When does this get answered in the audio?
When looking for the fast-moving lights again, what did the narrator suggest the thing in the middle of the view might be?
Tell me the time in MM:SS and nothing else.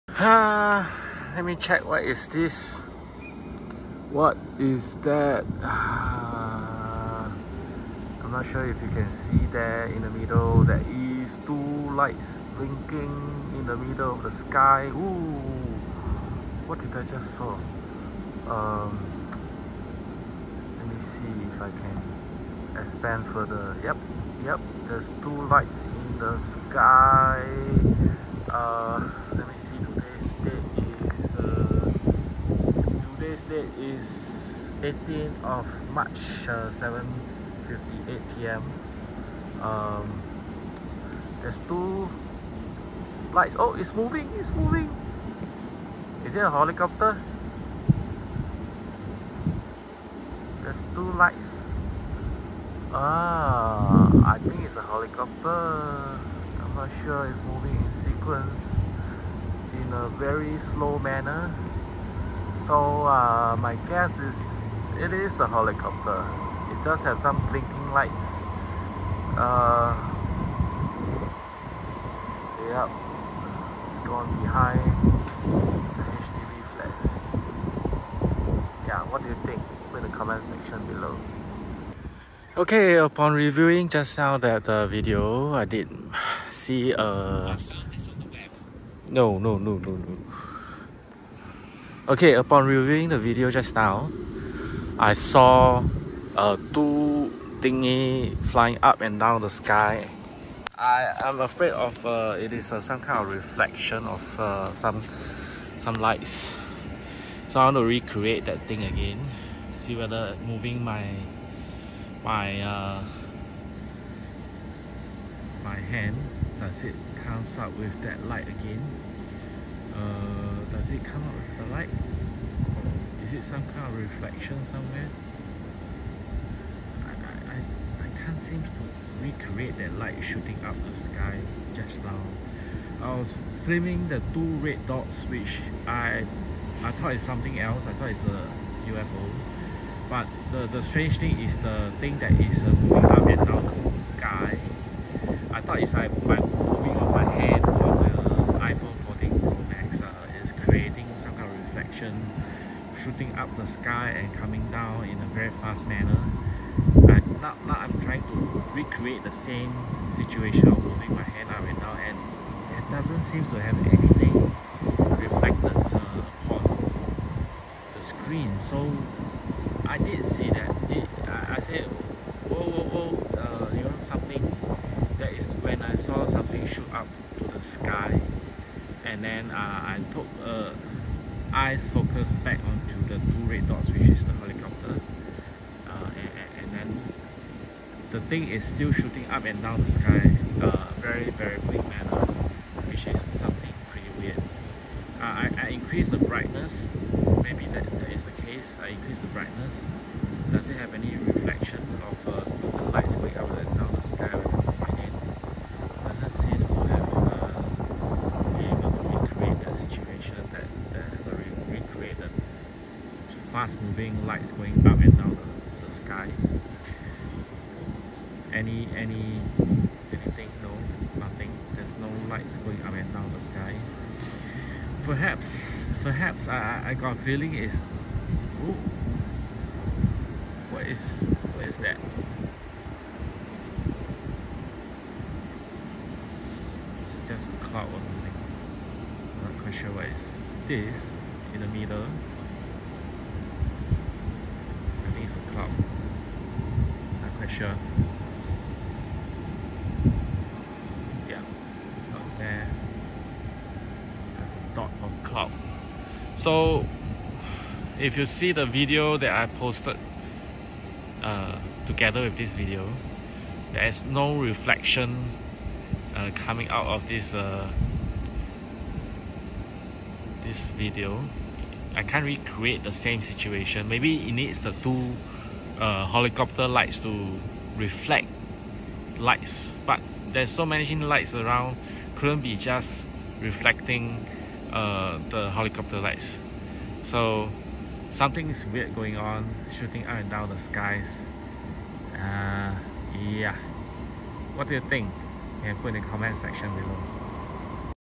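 04:14.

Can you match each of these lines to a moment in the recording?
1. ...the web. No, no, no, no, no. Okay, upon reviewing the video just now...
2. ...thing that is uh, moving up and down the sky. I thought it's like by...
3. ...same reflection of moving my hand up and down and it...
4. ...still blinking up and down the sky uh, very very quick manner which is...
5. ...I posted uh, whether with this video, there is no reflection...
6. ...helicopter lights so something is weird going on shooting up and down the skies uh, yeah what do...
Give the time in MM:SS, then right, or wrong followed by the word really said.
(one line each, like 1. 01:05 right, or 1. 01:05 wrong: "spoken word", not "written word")
1. 01:28 right
2. 02:21 right
3. 02:39 wrong: "situation", not "reflection"
4. 03:08 wrong: "shooting", not "blinking"
5. 04:19 wrong: "together", not "whether"
6. 04:45 right.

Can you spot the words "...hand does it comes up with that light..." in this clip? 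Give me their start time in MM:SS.
01:55.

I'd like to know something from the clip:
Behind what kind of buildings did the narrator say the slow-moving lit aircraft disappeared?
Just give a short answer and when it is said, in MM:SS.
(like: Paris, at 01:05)
HDB flats, at 01:16.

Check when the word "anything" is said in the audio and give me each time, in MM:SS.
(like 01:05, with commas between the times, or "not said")
02:43, 03:40.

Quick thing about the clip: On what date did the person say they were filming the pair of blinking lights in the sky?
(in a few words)
18th of March.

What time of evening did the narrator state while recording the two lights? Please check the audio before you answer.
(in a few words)
7:58 p.m.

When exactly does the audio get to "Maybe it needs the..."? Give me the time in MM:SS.
04:33.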